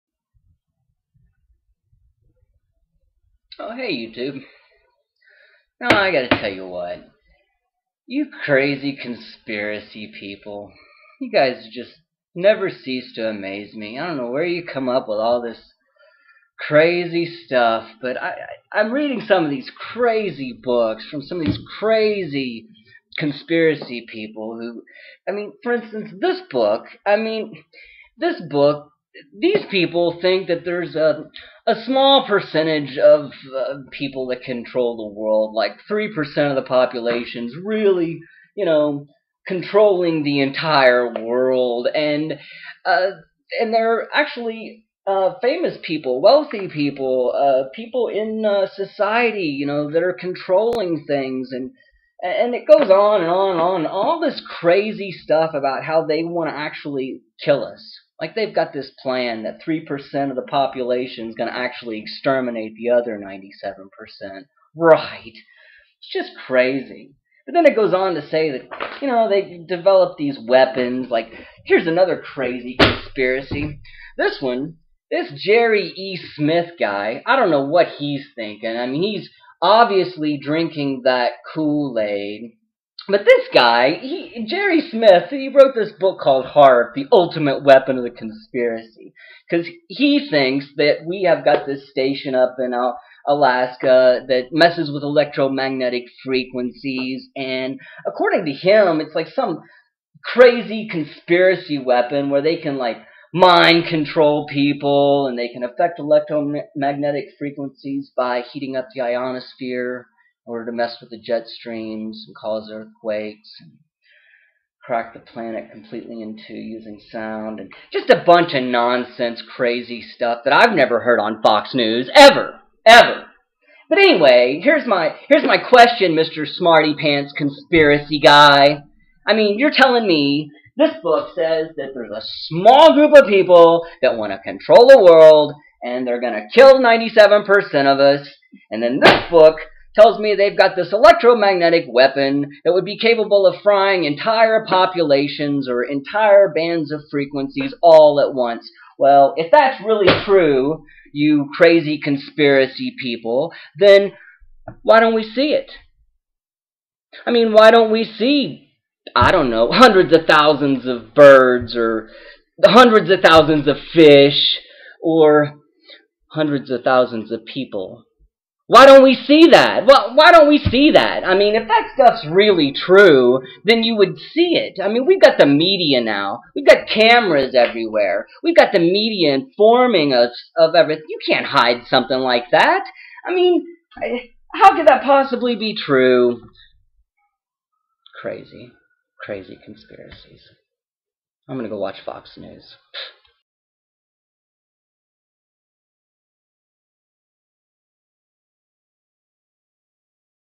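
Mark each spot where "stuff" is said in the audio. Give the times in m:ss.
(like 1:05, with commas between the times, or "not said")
0:17, 0:55, 2:00, 2:51.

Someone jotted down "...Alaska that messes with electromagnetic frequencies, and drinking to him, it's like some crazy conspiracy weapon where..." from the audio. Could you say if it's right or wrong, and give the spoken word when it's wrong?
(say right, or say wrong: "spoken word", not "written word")
wrong: "according", not "drinking".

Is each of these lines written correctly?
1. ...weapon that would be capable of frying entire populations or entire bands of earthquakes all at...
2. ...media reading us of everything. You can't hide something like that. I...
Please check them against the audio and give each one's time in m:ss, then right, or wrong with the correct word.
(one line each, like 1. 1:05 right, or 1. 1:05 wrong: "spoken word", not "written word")
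1. 2:21 wrong: "frequencies", not "earthquakes"
2. 2:58 wrong: "informing", not "reading".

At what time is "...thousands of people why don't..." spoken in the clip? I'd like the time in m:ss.
2:46.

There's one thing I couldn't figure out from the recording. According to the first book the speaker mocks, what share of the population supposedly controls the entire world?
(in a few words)
3%.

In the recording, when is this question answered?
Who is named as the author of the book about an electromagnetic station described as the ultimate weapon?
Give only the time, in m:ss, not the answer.
1:15.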